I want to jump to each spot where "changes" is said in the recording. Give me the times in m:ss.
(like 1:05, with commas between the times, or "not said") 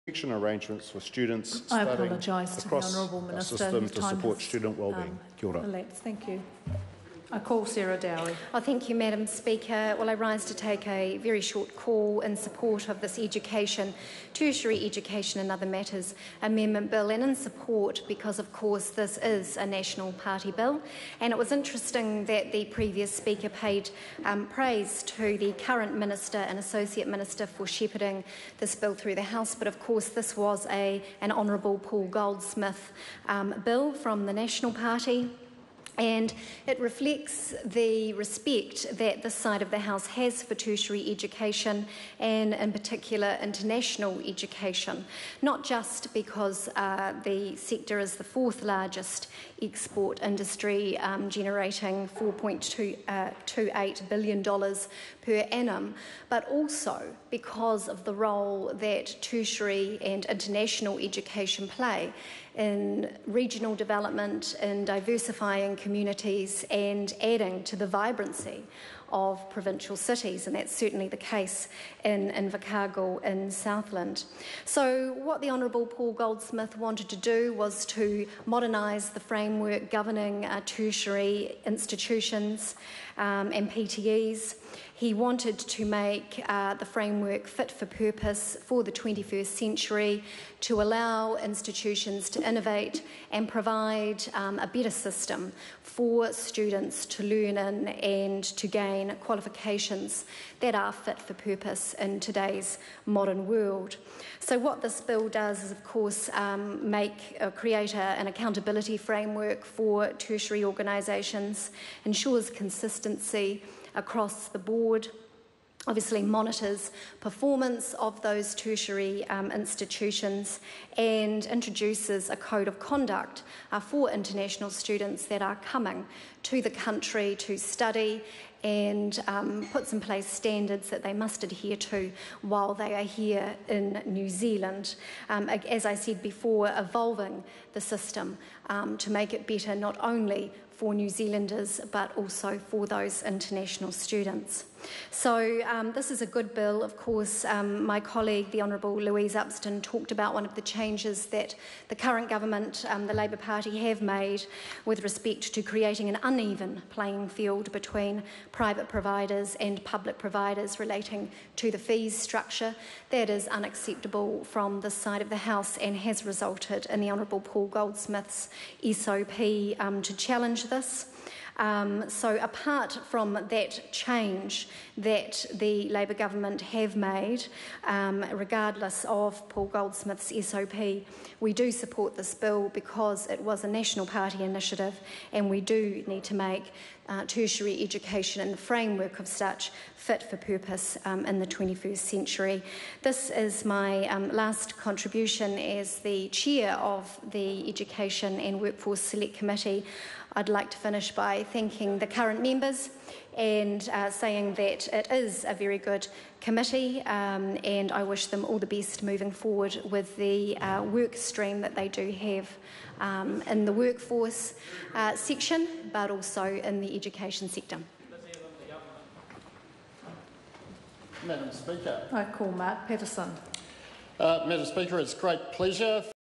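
2:30, 2:53.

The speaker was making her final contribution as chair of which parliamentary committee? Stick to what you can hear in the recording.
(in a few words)
Education and Workforce Select Committee.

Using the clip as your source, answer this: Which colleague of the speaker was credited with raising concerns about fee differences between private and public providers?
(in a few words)
Louise Upston.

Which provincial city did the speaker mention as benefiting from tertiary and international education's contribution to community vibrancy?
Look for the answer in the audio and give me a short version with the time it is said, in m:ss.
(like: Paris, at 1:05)
Invercargill, at 1:12.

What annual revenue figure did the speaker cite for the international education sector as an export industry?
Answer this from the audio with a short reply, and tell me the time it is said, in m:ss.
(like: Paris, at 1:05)
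$4.28 billion, at 0:52.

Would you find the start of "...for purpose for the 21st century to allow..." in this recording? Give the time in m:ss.
1:27.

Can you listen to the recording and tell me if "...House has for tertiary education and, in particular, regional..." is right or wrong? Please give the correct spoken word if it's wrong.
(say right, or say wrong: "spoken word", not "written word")
wrong: "international", not "regional".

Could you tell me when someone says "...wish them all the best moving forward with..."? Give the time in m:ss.
3:28.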